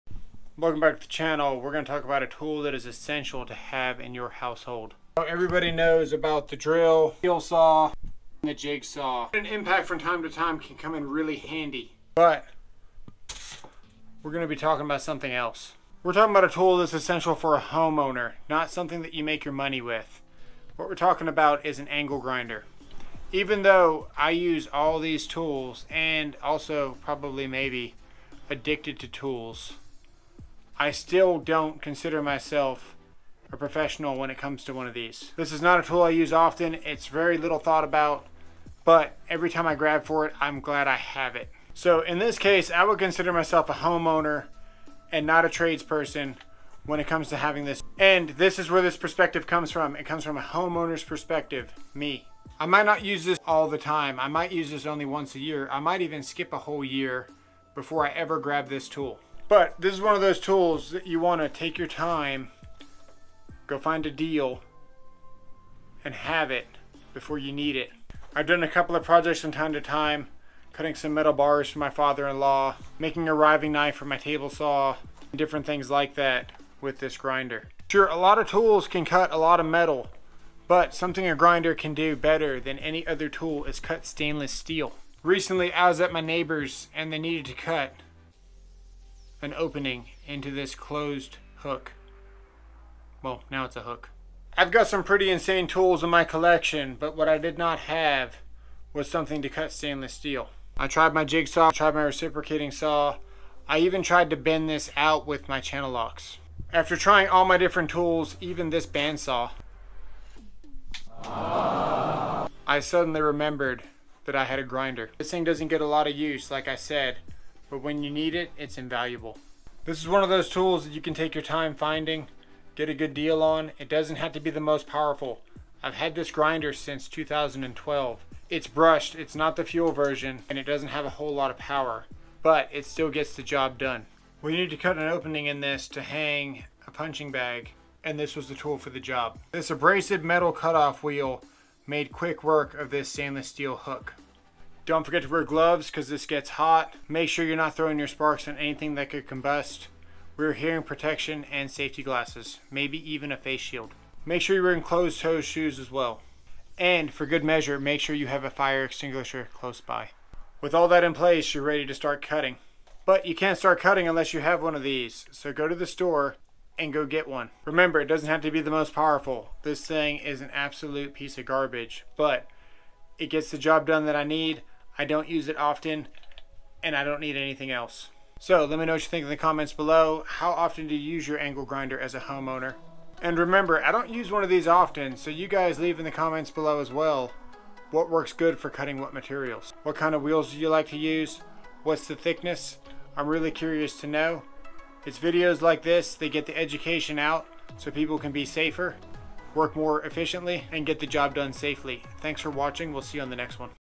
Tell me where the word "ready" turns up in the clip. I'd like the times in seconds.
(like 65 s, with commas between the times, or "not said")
161 s.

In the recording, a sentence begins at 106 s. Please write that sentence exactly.
After trying all my different tools, even this bandsaw, I suddenly remembered that I had a grinder.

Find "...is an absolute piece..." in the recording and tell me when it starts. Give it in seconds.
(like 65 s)
170 s.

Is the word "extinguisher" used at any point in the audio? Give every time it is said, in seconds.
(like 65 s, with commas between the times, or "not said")
158 s.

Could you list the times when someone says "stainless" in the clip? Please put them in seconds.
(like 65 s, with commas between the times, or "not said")
84 s, 99 s, 143 s.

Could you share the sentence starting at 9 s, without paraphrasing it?
An impact from time to time can come in really handy.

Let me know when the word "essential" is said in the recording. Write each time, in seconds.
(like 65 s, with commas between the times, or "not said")
2 s, 16 s.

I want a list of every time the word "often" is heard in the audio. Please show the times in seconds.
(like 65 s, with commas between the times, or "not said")
36 s, 175 s, 180 s, 184 s.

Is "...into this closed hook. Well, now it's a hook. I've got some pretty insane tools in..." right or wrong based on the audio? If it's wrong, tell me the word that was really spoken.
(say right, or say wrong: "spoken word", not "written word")
right.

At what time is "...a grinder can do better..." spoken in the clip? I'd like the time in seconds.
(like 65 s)
81 s.